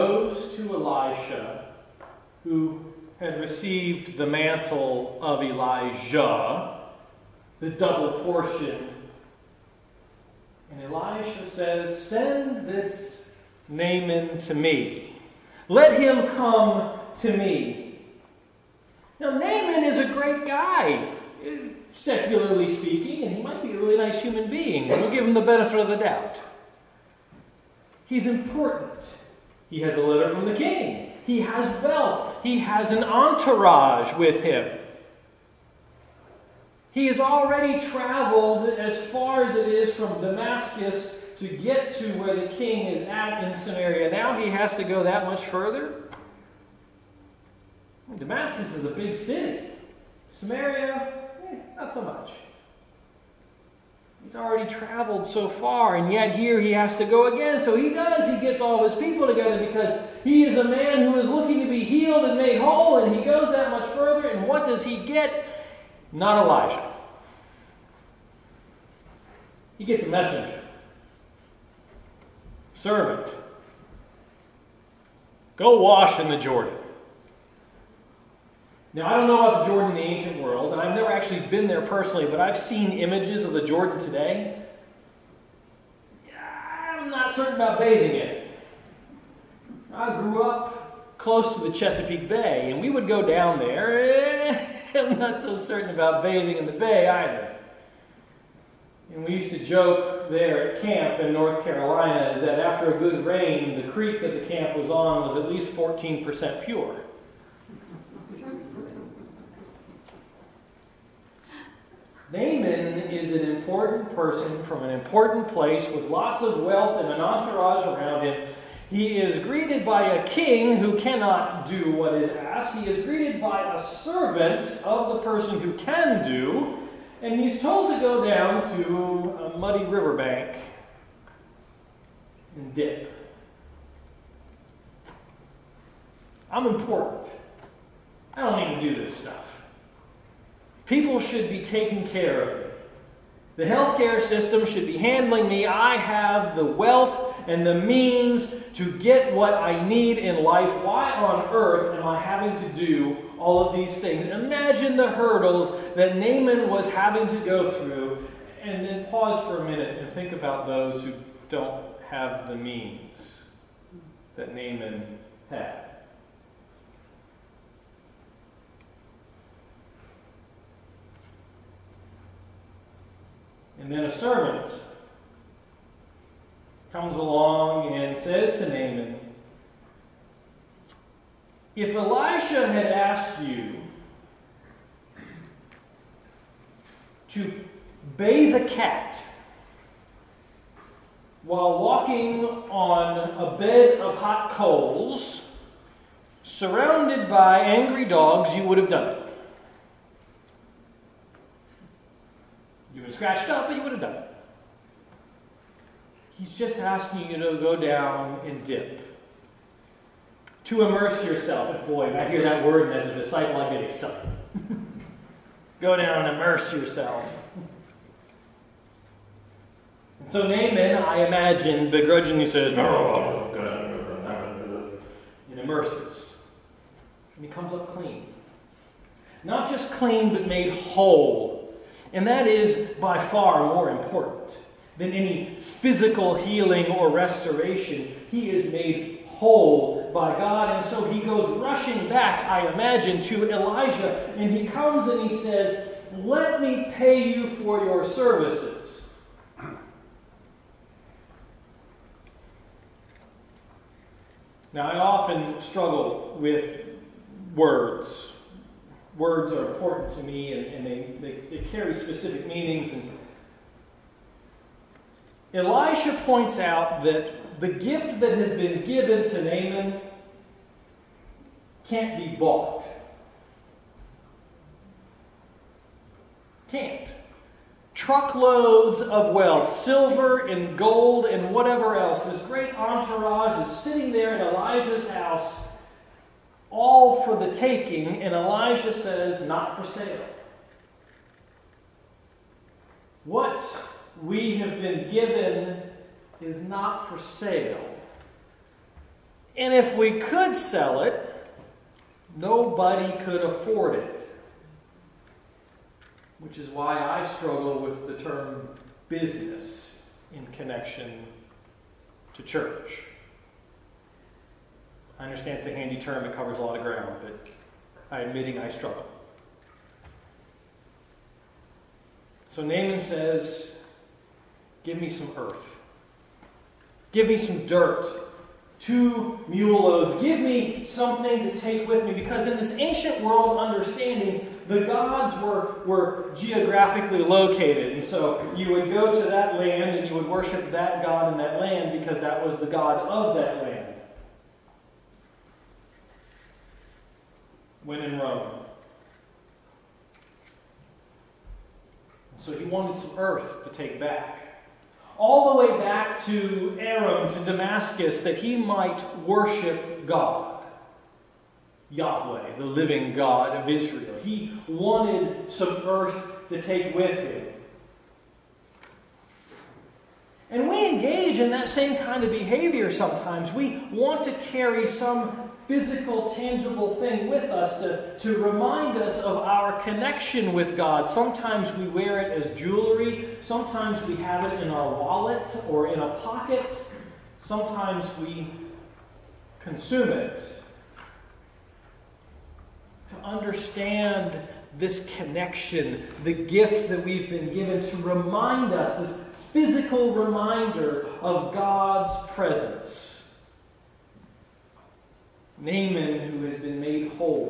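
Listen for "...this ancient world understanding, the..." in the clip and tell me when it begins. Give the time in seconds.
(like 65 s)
332 s.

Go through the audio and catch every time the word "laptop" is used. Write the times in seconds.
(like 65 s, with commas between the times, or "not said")
not said.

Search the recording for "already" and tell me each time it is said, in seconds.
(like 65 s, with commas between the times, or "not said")
37 s, 54 s.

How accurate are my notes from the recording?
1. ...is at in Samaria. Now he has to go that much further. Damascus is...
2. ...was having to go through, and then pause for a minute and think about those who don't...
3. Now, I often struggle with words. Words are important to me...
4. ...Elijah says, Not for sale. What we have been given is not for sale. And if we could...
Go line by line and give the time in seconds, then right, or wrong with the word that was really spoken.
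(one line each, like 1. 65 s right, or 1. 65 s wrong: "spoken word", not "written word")
1. 42 s right
2. 156 s right
3. 254 s right
4. 288 s right.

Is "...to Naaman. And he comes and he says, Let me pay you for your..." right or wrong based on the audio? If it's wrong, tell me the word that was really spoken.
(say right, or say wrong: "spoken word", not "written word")
wrong: "Elijah", not "Naaman".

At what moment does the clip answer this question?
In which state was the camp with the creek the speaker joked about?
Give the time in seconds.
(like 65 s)
101 s.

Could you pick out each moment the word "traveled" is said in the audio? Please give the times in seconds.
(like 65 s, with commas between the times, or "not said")
37 s, 54 s.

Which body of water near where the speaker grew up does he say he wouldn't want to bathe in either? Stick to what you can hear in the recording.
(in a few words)
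Chesapeake Bay.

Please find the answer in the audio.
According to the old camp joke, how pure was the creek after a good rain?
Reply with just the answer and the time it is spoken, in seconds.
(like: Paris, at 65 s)
14%, at 105 s.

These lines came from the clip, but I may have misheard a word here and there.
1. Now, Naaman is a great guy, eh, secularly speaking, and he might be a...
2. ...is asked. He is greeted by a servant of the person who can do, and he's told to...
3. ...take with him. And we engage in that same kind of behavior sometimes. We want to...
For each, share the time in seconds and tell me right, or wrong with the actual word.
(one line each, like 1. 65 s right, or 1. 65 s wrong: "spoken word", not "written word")
1. 19 s right
2. 122 s right
3. 366 s right.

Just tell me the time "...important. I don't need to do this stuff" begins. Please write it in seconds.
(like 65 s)
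136 s.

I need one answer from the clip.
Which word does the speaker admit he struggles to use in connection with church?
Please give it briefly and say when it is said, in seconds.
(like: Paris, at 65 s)
business, at 309 s.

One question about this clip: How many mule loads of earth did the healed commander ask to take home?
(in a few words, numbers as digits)
2.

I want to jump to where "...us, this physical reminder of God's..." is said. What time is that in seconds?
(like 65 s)
398 s.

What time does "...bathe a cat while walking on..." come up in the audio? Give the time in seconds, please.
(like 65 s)
188 s.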